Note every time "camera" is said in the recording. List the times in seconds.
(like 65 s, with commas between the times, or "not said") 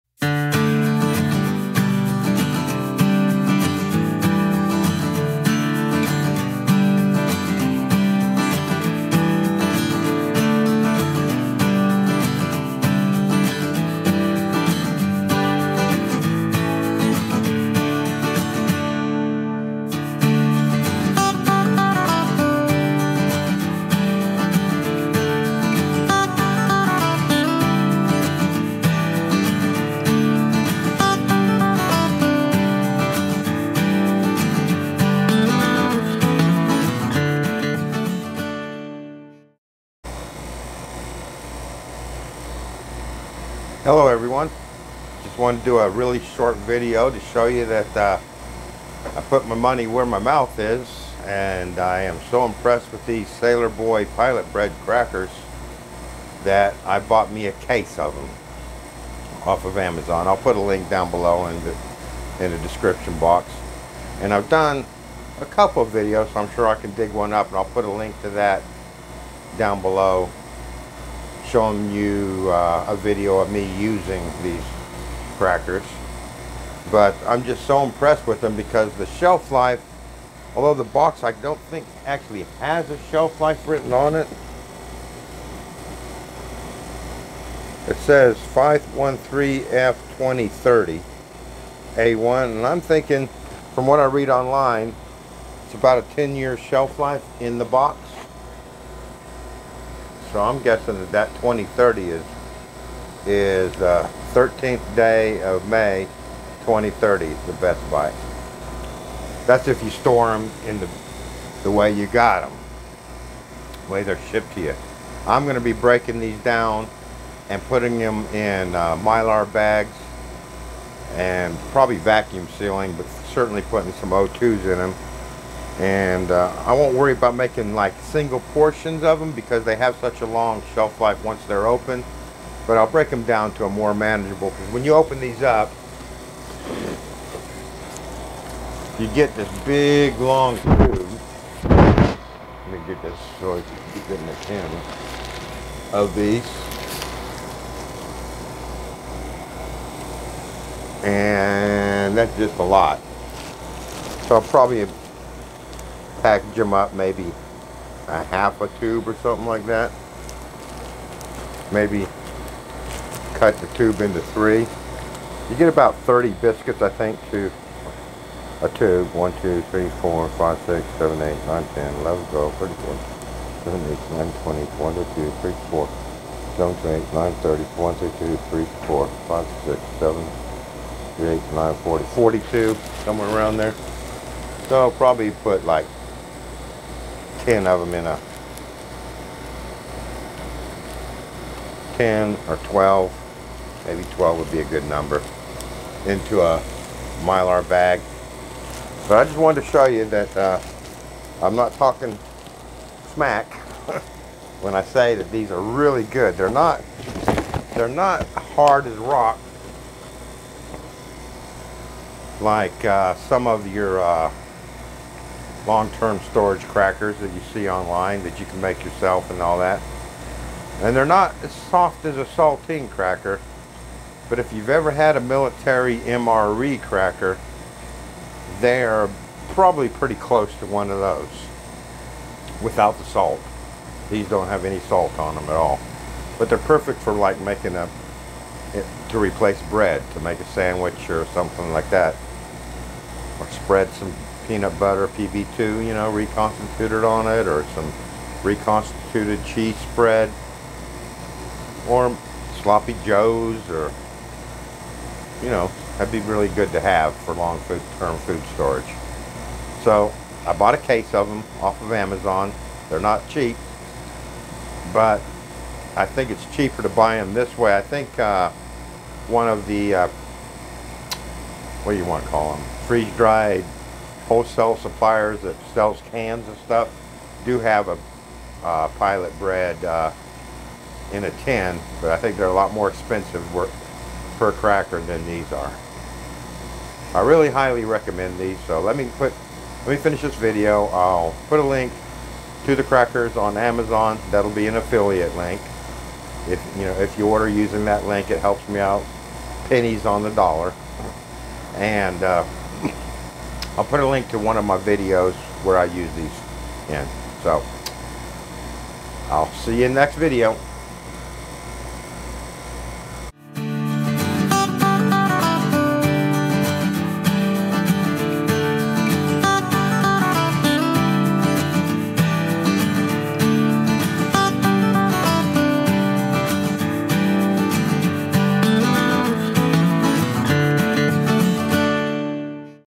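144 s.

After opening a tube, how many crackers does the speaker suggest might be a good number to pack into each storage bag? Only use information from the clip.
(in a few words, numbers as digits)
12.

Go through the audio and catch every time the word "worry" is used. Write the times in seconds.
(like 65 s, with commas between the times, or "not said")
126 s.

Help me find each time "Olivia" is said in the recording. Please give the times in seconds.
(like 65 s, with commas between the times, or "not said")
not said.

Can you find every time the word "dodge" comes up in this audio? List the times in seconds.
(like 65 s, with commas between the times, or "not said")
not said.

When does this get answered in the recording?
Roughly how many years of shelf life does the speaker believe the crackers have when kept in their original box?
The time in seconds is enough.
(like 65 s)
96 s.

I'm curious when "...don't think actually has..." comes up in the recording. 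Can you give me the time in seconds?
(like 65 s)
81 s.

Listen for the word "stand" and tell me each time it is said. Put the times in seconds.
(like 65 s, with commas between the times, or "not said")
not said.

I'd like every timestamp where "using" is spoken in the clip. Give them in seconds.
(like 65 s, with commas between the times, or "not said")
73 s, 297 s.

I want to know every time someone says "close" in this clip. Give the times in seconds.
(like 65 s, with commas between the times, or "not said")
230 s.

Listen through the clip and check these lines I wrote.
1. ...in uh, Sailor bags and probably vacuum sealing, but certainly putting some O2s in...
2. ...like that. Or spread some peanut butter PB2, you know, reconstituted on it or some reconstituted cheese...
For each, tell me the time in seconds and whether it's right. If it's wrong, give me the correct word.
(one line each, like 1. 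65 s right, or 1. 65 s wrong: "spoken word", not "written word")
1. 118 s wrong: "Mylar", not "Sailor"
2. 241 s right.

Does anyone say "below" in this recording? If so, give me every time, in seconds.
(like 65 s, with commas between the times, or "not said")
61 s, 69 s.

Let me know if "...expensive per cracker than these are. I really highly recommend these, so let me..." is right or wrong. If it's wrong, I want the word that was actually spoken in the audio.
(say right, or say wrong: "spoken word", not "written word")
right.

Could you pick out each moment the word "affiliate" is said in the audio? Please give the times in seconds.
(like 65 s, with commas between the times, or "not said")
294 s.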